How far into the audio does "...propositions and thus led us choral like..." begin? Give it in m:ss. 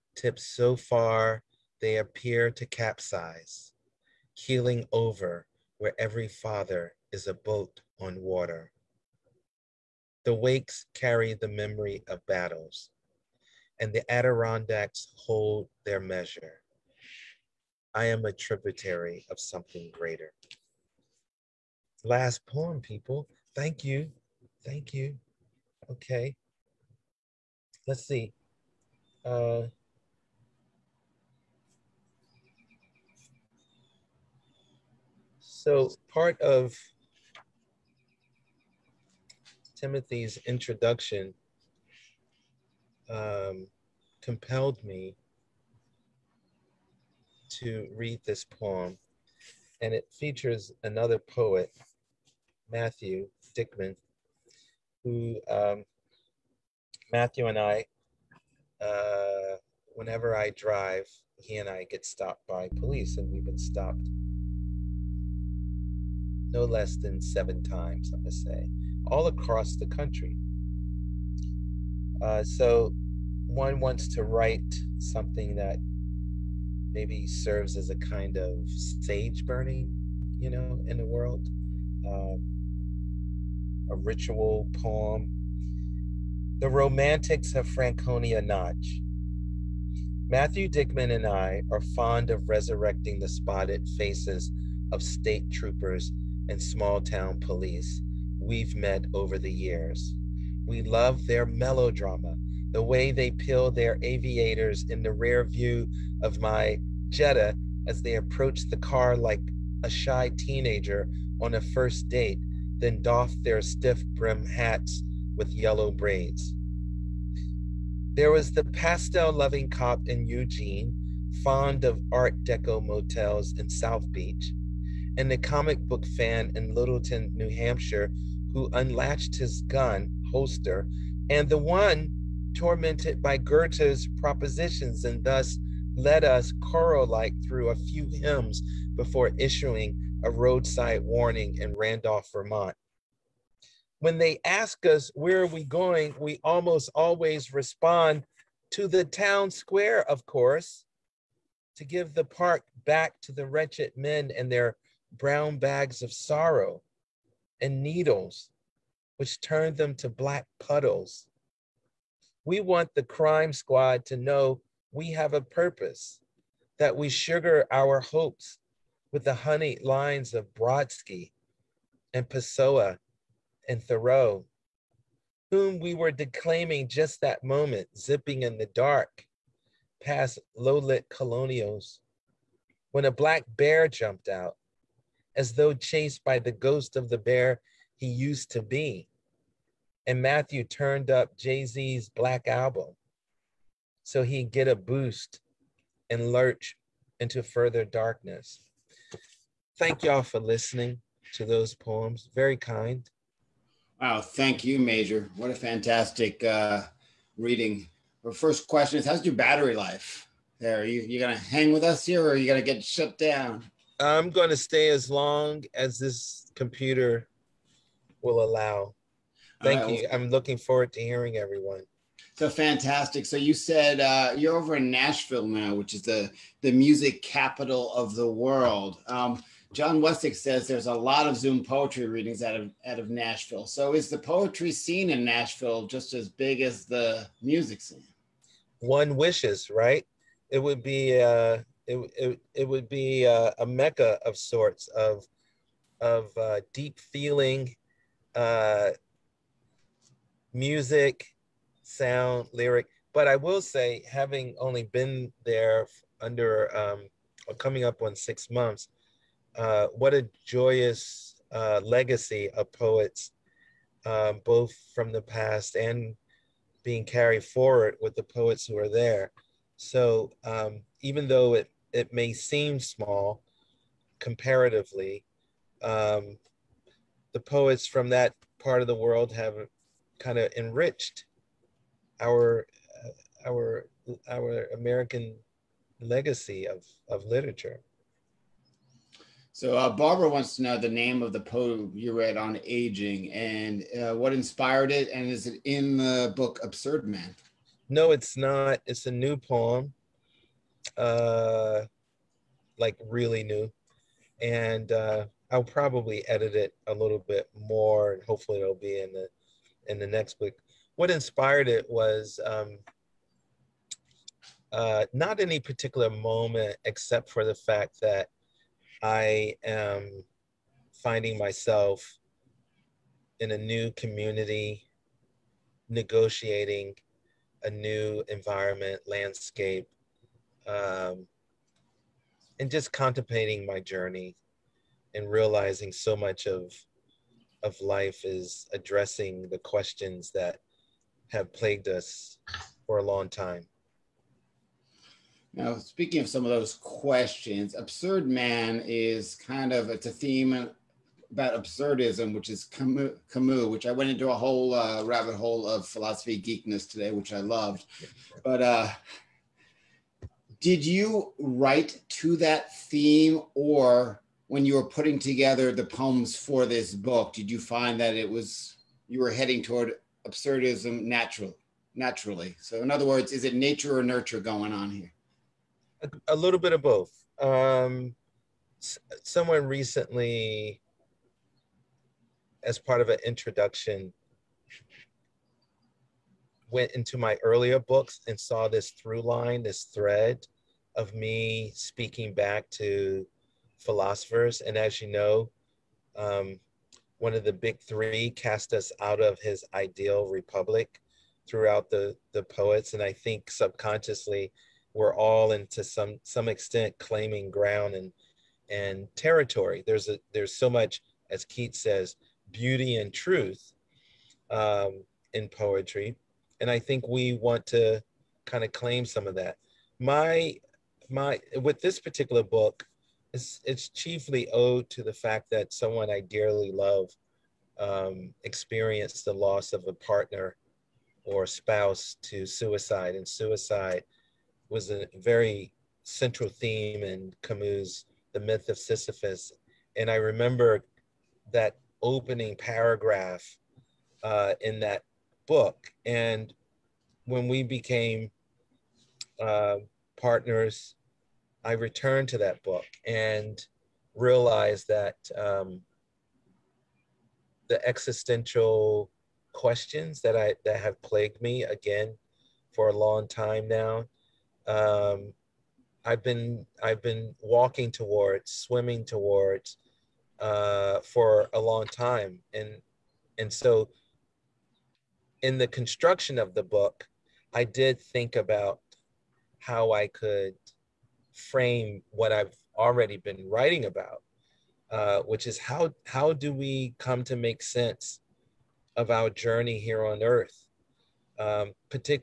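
2:14.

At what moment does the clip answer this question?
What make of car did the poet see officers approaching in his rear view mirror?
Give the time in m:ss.
1:47.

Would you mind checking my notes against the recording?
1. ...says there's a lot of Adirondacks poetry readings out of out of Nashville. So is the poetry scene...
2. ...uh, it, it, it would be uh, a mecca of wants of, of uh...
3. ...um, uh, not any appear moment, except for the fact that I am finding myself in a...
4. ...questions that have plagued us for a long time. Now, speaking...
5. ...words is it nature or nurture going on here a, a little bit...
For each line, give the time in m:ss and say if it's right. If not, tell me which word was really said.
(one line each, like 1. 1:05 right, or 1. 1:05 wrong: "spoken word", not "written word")
1. 3:50 wrong: "Zoom", not "Adirondacks"
2. 4:01 wrong: "sorts", not "wants"
3. 5:12 wrong: "particular", not "appear"
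4. 5:39 right
5. 6:13 right.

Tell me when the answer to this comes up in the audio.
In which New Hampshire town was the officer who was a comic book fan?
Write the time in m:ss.
2:06.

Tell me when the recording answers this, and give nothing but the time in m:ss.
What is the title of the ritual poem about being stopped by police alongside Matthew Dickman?
1:26.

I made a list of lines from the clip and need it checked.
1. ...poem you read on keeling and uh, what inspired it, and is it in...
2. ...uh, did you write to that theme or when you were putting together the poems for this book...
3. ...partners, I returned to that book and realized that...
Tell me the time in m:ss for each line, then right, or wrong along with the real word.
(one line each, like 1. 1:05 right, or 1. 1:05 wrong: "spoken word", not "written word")
1. 4:51 wrong: "aging", not "keeling"
2. 5:58 right
3. 7:30 right.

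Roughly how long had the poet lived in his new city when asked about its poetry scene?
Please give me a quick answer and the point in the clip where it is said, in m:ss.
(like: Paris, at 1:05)
six months, at 4:18.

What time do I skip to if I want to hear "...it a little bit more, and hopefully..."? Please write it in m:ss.
5:06.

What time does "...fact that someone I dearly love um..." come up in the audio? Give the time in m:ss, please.
7:05.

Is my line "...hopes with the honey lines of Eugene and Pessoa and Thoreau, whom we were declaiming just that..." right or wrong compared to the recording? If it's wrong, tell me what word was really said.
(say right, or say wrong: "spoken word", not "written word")
wrong: "Brodsky", not "Eugene".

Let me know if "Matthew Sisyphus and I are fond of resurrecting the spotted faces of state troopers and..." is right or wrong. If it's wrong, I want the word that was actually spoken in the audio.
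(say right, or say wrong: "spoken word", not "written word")
wrong: "Dickman", not "Sisyphus".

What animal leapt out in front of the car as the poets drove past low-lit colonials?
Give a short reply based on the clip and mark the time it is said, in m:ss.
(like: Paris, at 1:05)
black bear, at 3:03.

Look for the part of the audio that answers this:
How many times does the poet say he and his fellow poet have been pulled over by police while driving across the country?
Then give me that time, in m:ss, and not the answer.
1:07.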